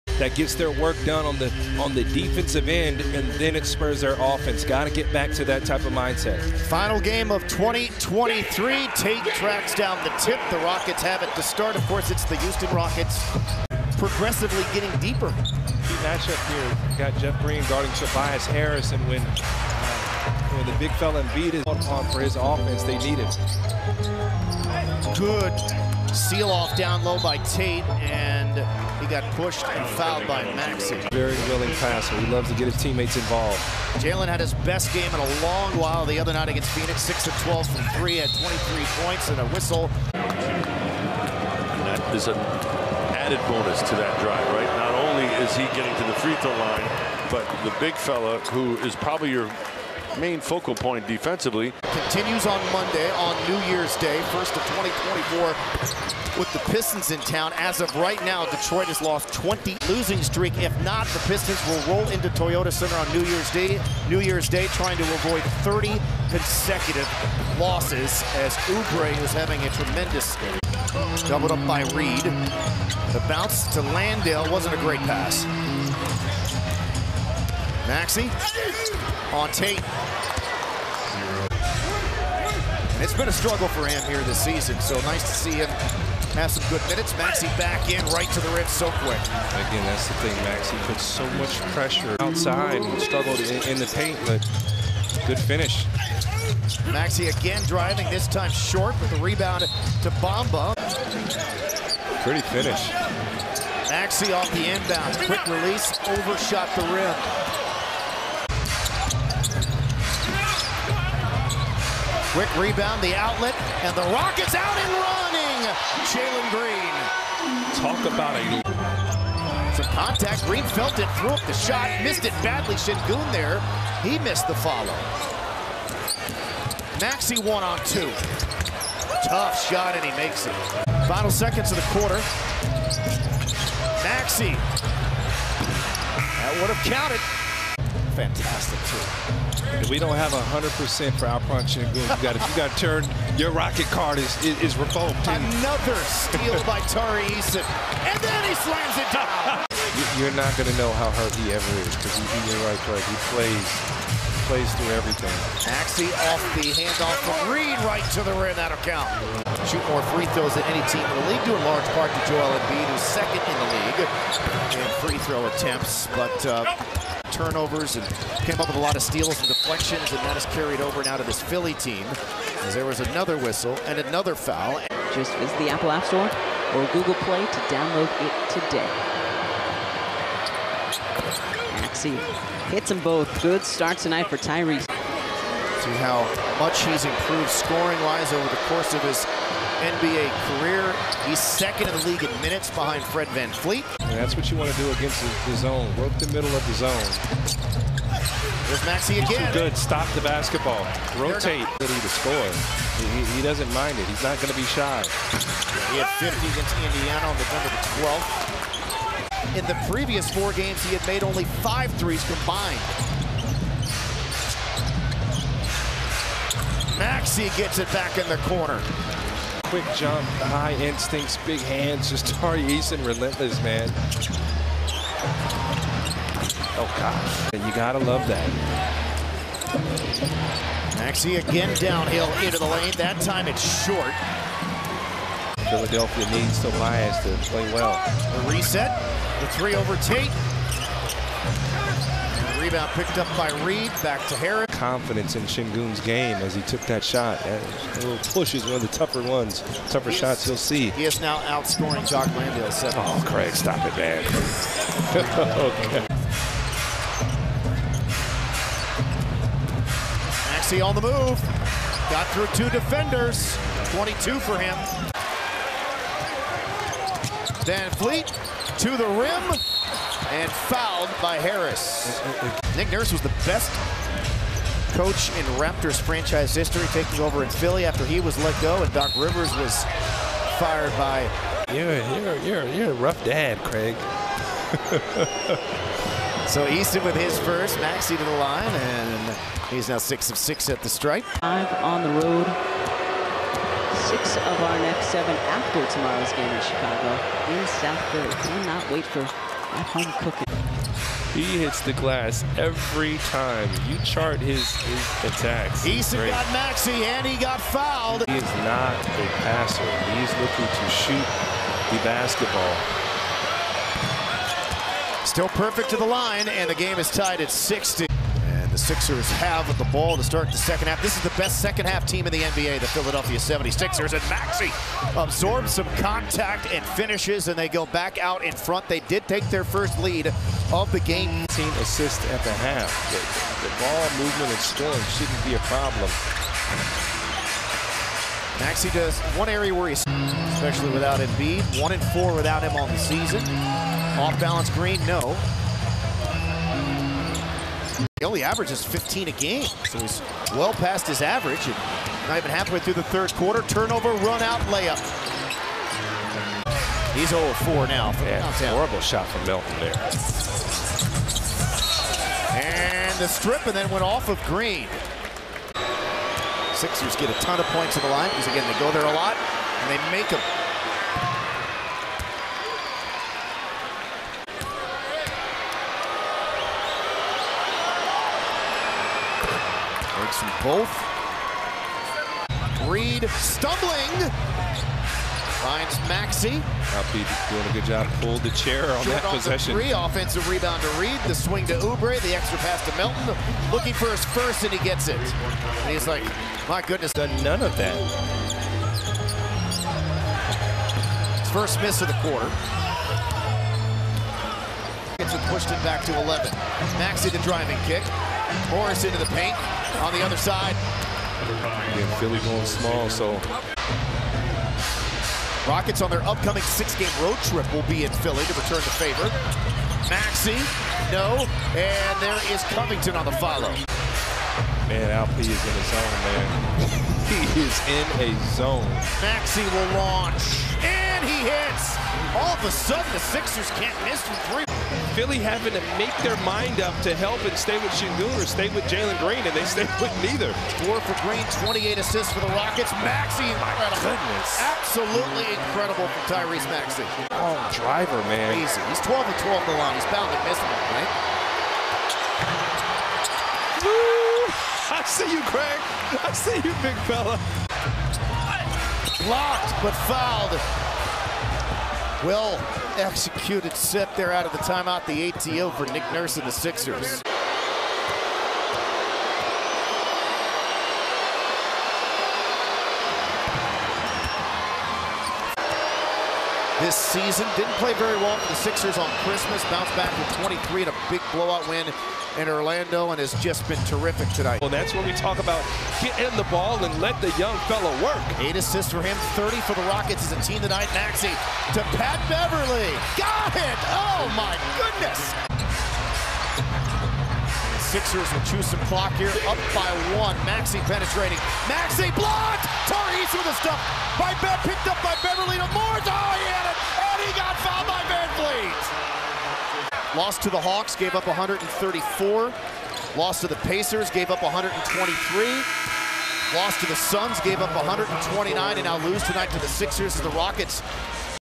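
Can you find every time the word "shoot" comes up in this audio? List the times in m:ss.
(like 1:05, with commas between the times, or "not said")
2:39, 5:10.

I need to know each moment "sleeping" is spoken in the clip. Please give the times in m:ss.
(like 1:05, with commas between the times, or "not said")
not said.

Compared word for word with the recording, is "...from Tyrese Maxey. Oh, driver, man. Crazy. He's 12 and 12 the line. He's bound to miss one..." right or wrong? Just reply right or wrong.
right.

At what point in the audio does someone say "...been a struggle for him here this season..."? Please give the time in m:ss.
1:23.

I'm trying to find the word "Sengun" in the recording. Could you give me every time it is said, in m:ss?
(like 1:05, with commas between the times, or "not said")
2:02, 4:05, 7:17.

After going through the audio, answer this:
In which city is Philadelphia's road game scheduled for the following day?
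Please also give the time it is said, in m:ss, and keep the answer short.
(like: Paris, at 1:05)
Chicago, at 4:56.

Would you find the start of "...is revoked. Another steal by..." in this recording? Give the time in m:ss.
2:24.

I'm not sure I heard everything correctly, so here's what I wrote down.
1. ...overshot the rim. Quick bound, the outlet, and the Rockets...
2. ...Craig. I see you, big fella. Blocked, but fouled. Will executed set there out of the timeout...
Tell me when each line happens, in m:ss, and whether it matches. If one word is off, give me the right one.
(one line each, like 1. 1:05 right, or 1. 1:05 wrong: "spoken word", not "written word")
1. 1:46 wrong: "rebound", not "bound"
2. 7:35 right.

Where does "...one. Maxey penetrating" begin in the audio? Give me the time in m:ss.
8:20.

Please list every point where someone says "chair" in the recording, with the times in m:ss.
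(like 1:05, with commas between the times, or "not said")
6:28.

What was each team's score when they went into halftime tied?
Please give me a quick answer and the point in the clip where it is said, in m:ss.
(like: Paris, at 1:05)
60, at 5:17.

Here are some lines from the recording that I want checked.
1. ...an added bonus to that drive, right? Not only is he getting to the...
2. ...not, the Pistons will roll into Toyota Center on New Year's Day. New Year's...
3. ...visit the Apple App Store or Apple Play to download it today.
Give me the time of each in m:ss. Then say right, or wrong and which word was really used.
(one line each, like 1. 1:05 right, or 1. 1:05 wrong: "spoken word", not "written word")
1. 0:42 right
2. 1:00 right
3. 2:55 wrong: "Google", not "Apple".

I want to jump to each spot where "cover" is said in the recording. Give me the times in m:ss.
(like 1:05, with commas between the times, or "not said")
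not said.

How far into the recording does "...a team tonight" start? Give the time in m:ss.
8:10.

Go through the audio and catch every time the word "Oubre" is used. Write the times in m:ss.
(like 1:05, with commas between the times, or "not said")
1:08, 6:31.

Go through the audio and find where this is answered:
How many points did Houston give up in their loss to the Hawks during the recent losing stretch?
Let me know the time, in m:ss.
8:31.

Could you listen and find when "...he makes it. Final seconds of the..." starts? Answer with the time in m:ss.
2:10.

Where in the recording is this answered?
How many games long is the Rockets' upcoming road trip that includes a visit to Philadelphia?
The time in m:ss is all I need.
6:56.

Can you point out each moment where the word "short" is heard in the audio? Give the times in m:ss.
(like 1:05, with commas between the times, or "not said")
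1:38, 3:53, 6:29.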